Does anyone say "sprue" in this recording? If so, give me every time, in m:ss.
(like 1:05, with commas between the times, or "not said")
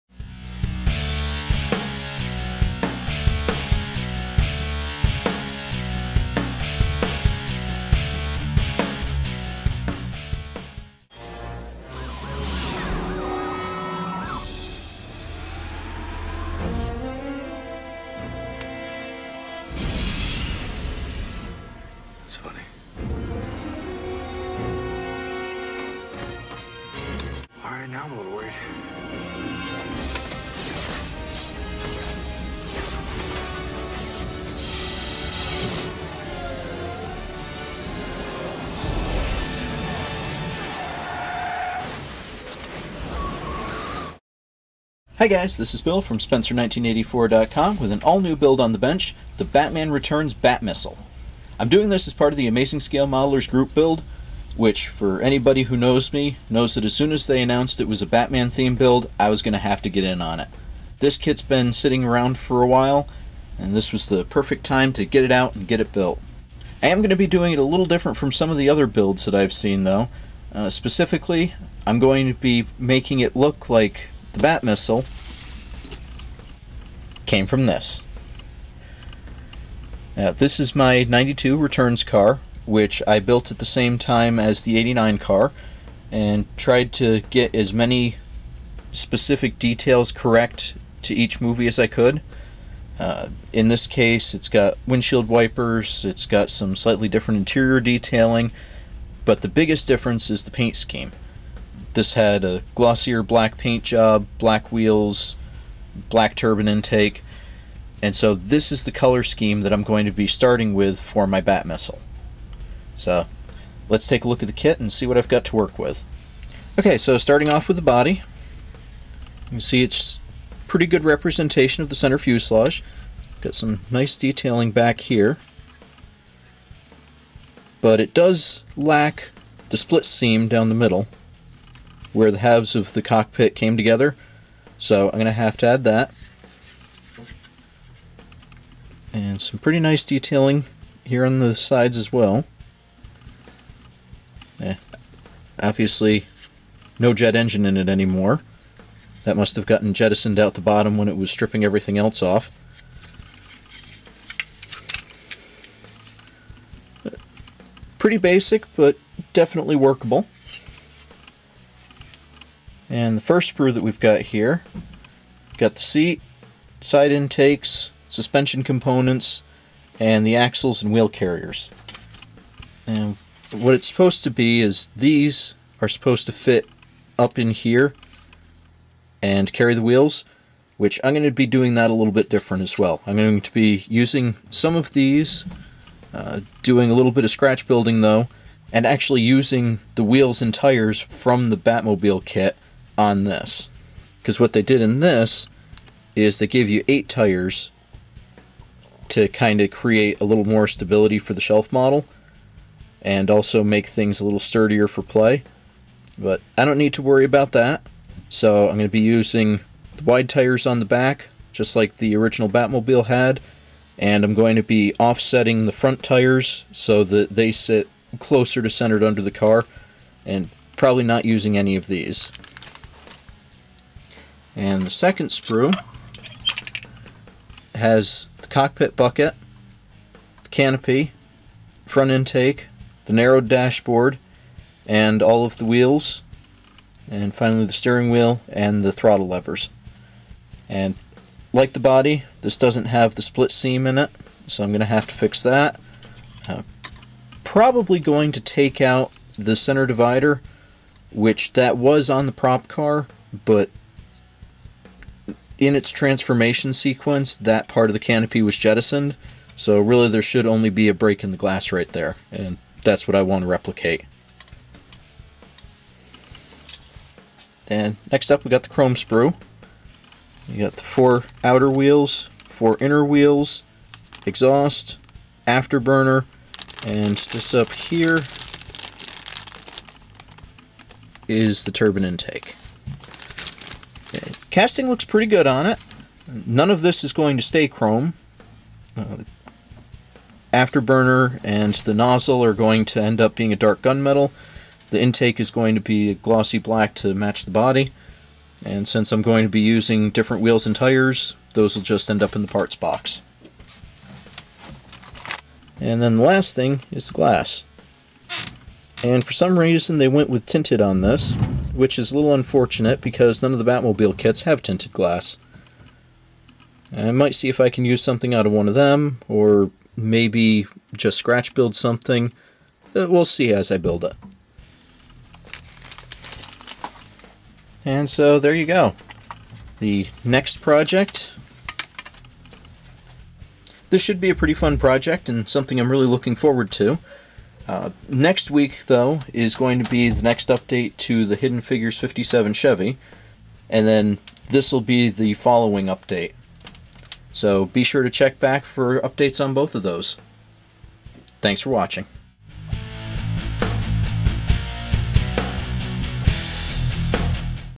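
2:43, 3:45, 4:28.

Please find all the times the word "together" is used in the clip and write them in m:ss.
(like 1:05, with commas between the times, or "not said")
2:13.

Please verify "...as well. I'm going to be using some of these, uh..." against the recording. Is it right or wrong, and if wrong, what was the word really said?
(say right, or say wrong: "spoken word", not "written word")
right.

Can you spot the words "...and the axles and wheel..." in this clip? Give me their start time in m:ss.
2:49.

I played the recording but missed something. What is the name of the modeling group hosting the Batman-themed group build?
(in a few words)
Amazing Scale Modelers.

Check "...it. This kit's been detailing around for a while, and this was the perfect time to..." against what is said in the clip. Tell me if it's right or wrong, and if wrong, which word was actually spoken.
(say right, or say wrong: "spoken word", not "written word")
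wrong: "sitting", not "detailing".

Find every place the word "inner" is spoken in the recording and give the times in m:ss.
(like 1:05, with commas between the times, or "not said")
4:32.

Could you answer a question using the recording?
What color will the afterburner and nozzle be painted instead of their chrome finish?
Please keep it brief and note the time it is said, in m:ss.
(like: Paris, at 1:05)
Dark gunmetal, at 4:53.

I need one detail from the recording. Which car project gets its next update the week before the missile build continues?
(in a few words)
Hidden Figures 57 Chevy.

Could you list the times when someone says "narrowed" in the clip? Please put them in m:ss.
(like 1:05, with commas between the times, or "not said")
3:53.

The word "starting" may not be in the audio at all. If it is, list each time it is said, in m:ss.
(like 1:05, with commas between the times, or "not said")
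1:50, 1:57.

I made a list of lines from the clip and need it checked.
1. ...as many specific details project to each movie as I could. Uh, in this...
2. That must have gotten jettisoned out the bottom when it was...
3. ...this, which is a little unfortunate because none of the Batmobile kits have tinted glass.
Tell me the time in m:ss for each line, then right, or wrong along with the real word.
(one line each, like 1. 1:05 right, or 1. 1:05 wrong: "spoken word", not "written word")
1. 1:27 wrong: "correct", not "project"
2. 2:29 right
3. 5:11 right.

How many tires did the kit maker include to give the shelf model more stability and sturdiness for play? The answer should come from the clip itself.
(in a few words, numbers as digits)
8.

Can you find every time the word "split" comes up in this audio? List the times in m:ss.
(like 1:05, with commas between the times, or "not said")
2:09, 4:03.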